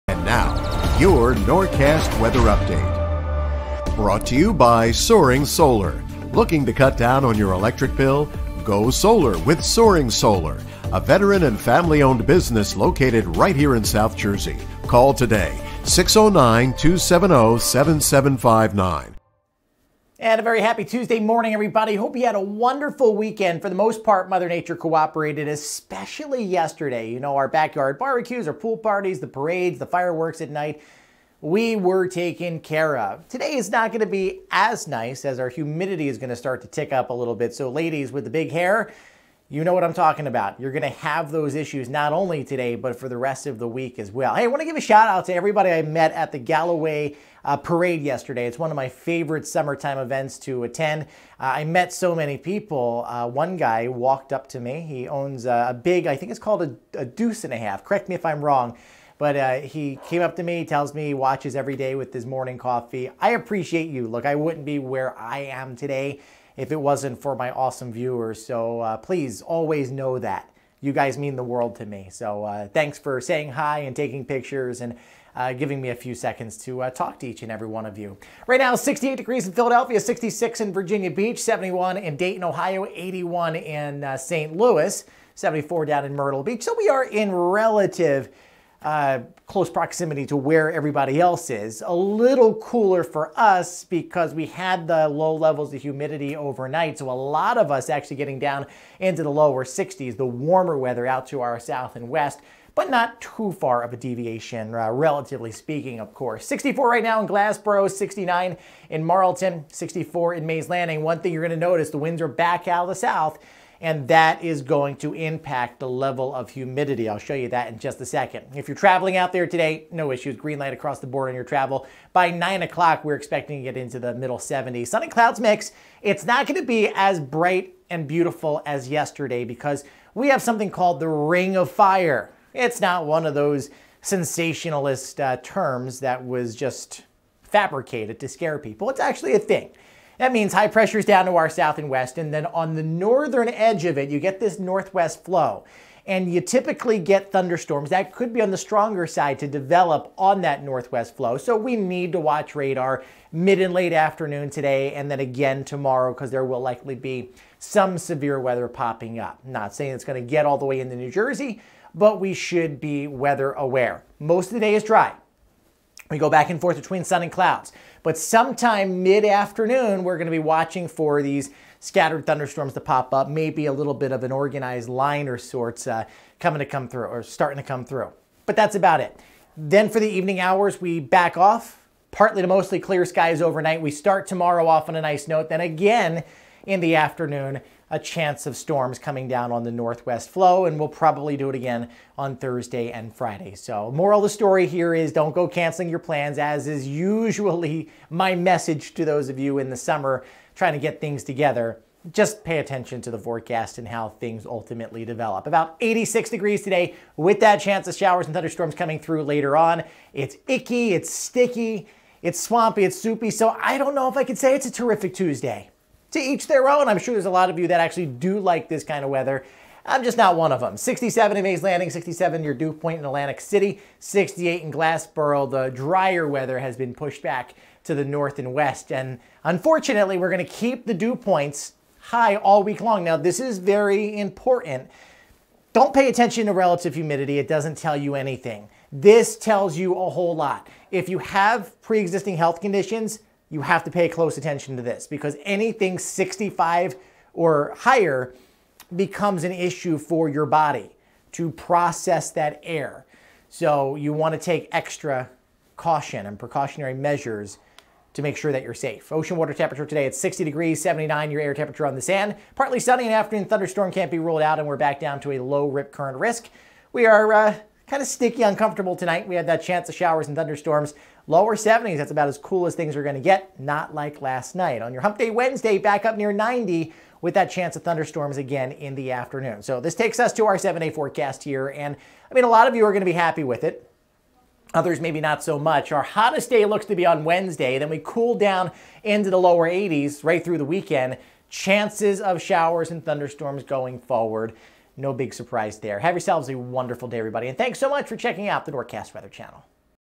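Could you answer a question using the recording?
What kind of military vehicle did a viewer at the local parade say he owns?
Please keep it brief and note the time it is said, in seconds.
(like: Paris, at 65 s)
deuce and a half, at 57 s.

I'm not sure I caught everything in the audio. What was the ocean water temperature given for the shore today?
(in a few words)
60 degrees.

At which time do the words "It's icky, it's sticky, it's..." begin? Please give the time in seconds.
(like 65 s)
210 s.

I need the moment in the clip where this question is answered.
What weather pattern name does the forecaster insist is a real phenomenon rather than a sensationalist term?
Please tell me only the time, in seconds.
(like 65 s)
131 s.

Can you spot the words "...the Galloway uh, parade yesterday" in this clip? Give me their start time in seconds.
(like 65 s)
46 s.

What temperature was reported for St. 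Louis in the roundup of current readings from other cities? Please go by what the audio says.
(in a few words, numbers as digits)
81.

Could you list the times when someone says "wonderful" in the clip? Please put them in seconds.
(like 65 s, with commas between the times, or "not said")
22 s, 296 s.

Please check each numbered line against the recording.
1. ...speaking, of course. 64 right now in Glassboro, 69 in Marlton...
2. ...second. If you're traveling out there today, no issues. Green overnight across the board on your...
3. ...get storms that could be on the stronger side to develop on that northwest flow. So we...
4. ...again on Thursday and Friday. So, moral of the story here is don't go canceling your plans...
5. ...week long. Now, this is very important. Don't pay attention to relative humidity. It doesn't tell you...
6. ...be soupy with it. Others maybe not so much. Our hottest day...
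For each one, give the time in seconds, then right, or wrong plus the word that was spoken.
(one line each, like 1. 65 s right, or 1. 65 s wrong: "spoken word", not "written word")
1. 105 s right
2. 118 s wrong: "light", not "overnight"
3. 146 s wrong: "thunderstorms", not "storms"
4. 191 s right
5. 232 s right
6. 283 s wrong: "happy", not "soupy".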